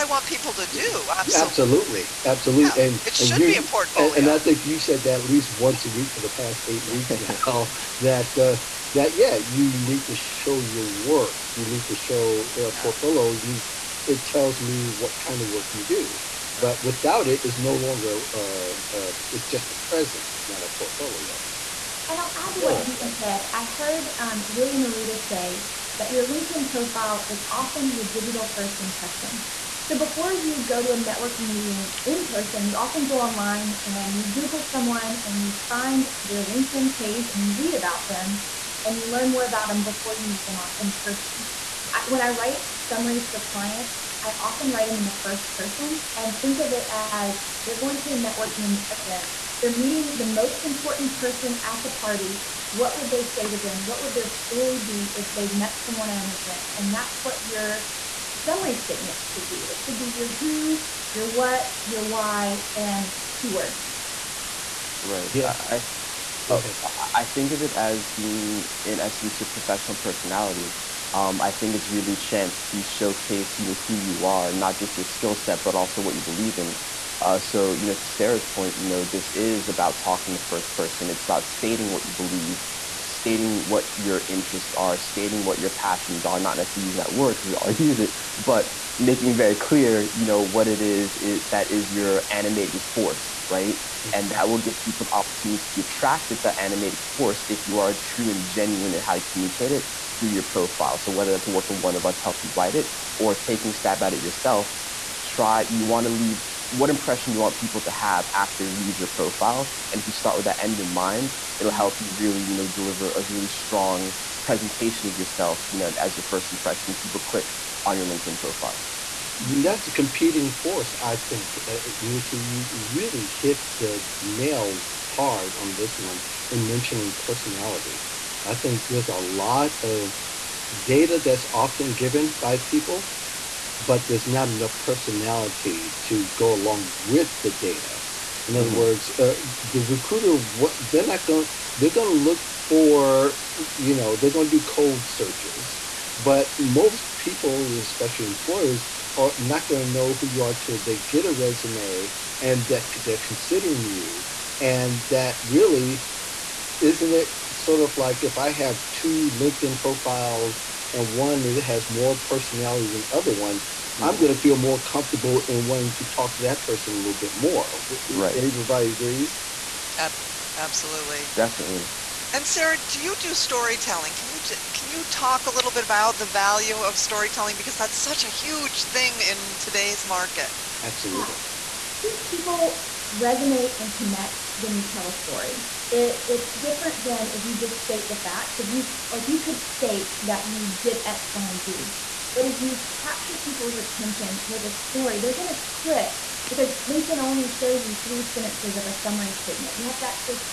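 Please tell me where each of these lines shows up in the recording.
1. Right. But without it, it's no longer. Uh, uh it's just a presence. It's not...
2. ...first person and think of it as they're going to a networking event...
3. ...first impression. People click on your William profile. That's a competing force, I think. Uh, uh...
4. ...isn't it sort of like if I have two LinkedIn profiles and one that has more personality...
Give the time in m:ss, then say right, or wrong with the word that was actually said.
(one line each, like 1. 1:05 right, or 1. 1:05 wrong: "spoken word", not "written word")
1. 0:16 right
2. 0:45 right
3. 1:56 wrong: "LinkedIn", not "William"
4. 2:36 right.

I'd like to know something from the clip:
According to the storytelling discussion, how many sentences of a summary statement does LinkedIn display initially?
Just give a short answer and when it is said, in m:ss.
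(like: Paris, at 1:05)
3, at 3:18.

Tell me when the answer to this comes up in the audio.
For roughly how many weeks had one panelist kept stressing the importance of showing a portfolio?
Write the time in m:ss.
0:06.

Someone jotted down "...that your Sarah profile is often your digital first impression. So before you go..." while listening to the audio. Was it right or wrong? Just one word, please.
wrong.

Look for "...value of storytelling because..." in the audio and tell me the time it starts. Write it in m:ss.
2:56.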